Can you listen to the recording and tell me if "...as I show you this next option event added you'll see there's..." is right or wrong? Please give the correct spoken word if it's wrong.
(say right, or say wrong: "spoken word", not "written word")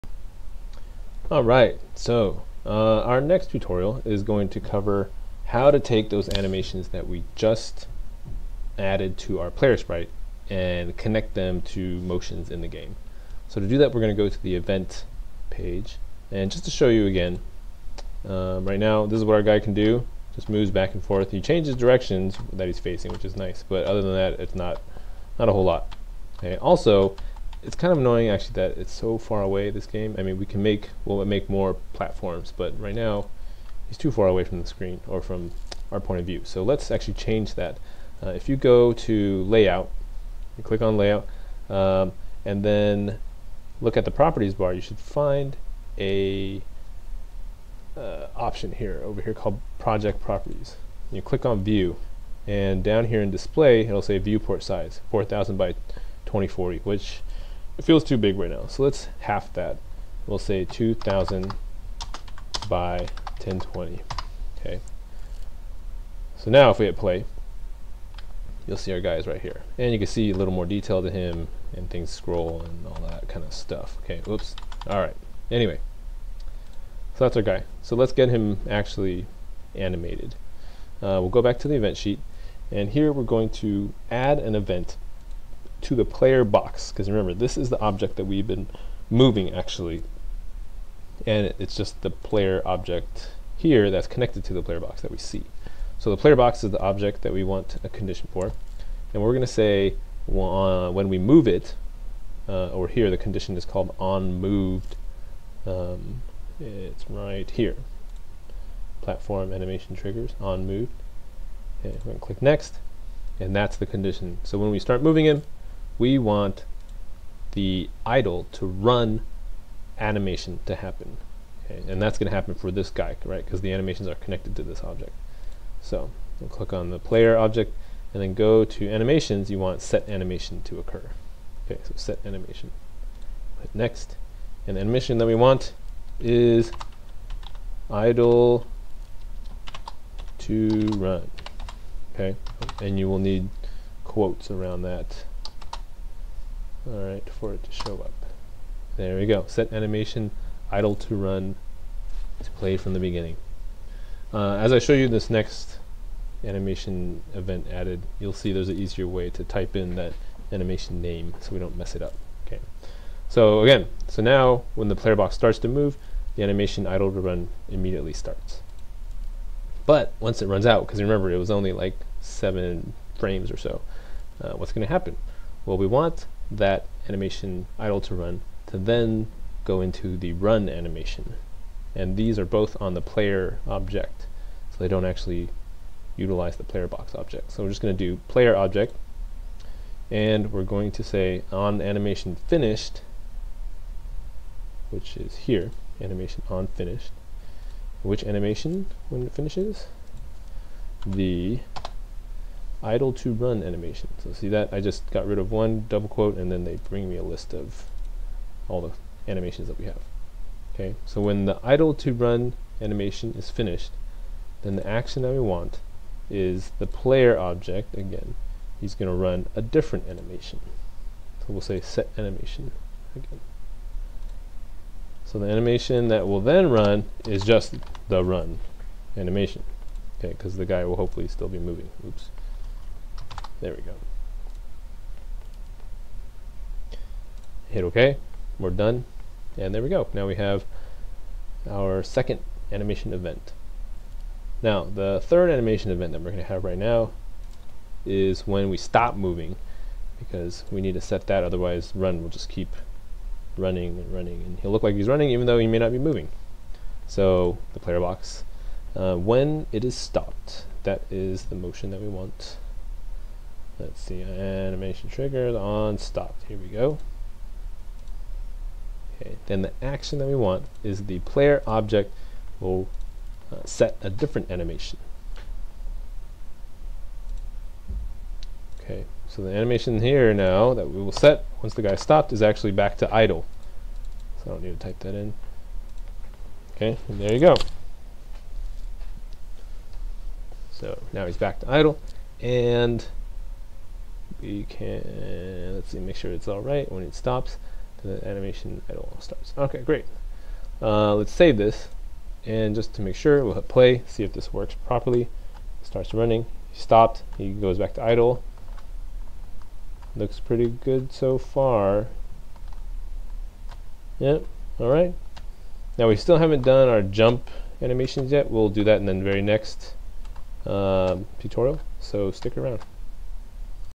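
wrong: "animation", not "option".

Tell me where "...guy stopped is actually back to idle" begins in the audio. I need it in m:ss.
4:41.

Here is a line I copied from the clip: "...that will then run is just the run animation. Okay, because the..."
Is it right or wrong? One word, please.
right.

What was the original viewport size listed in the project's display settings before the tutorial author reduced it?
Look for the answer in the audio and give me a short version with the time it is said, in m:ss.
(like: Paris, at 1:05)
4000 by 2040, at 0:55.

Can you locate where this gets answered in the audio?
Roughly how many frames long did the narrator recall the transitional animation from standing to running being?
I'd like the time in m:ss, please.
2:52.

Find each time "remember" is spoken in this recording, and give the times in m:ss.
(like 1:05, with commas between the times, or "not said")
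1:27, 2:50.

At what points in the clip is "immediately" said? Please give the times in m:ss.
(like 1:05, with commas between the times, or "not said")
2:47.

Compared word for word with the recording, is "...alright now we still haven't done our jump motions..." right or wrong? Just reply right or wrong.
wrong.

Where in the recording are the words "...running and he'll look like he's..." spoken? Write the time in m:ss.
4:14.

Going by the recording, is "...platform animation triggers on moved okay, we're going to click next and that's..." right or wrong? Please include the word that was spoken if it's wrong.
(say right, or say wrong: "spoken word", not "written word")
right.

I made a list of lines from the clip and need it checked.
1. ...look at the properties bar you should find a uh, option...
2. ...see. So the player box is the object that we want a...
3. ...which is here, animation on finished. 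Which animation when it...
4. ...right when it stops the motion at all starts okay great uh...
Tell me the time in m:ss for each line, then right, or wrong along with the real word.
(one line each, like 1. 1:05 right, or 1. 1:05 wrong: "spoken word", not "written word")
1. 0:43 right
2. 1:35 right
3. 3:14 right
4. 4:56 wrong: "animation", not "motion".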